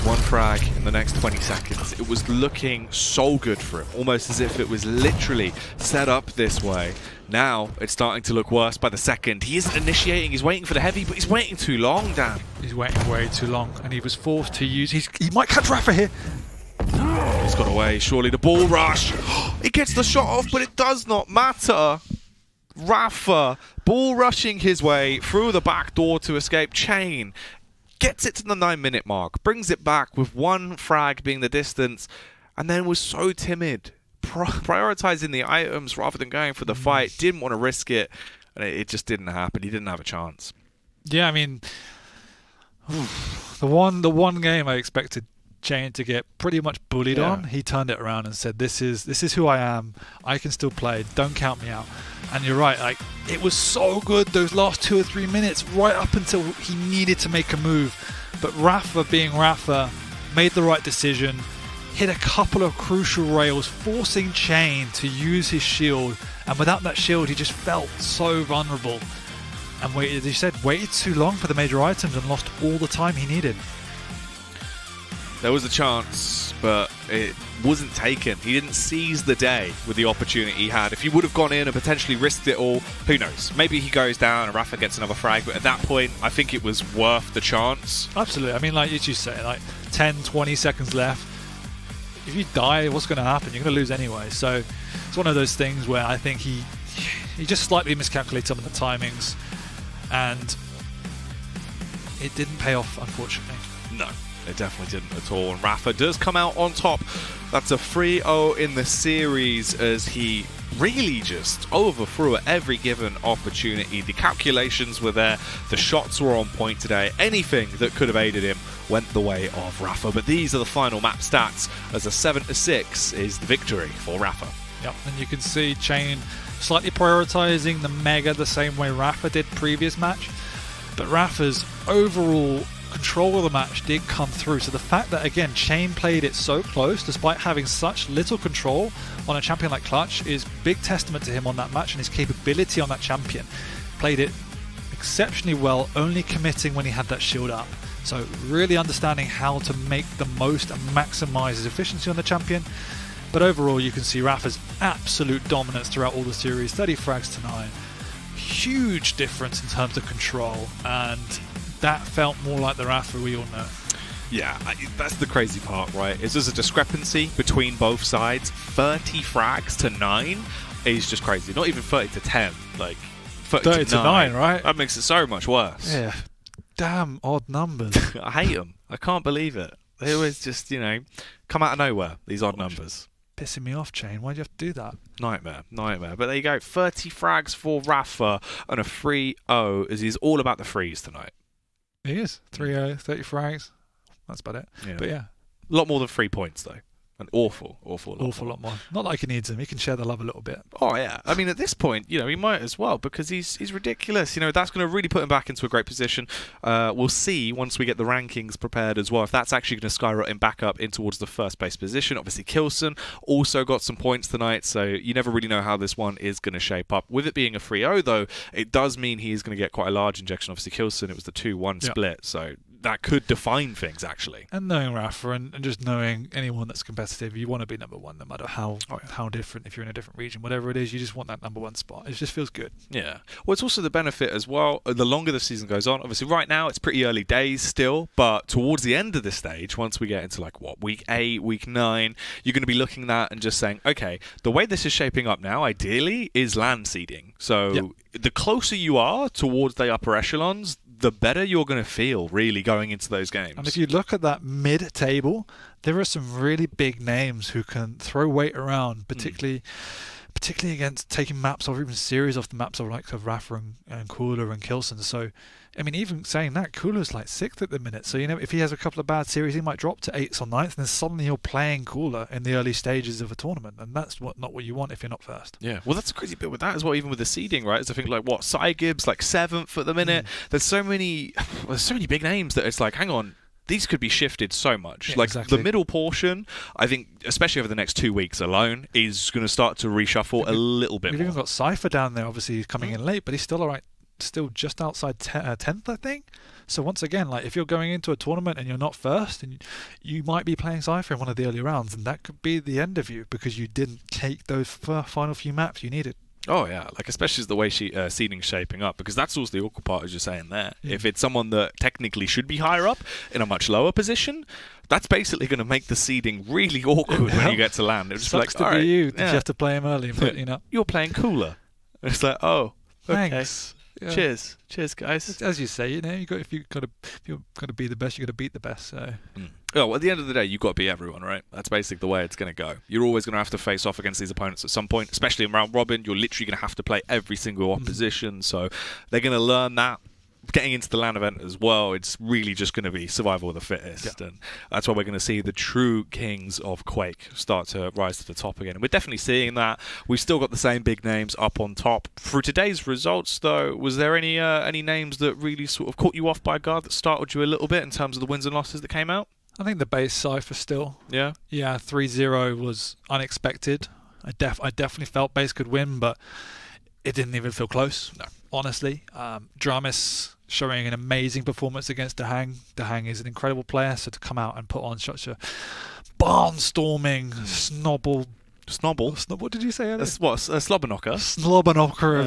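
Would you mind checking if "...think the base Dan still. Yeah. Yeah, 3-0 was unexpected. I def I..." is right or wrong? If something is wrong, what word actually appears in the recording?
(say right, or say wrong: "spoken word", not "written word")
wrong: "Cypher", not "Dan".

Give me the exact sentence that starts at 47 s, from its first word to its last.
on, he turned it around and said, "This is this is who I am.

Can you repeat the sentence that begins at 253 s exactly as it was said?
And if you look at that mid table, there are some really big names who can throw weight around, hmm.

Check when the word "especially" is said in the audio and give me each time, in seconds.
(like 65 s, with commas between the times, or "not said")
287 s, 307 s, 335 s.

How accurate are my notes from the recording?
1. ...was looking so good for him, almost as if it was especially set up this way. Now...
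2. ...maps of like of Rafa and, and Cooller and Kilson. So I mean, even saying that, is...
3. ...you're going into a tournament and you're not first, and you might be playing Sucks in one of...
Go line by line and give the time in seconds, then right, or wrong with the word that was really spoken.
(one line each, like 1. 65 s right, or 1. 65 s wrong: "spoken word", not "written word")
1. 2 s wrong: "literally", not "especially"
2. 262 s right
3. 297 s wrong: "Cypher", not "Sucks".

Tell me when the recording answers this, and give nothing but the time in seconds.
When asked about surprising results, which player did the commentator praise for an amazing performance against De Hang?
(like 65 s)
369 s.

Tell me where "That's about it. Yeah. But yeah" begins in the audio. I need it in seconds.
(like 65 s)
194 s.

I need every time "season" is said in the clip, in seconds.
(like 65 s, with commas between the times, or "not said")
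235 s.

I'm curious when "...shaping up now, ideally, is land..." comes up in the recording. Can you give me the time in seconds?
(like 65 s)
244 s.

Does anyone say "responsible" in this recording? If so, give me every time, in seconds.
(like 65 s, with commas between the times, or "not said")
not said.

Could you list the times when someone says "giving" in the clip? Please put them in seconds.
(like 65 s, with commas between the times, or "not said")
not said.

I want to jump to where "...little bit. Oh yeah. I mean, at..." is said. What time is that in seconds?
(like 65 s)
200 s.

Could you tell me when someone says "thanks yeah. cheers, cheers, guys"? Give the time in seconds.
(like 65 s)
323 s.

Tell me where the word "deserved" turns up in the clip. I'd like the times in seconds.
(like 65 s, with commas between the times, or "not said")
not said.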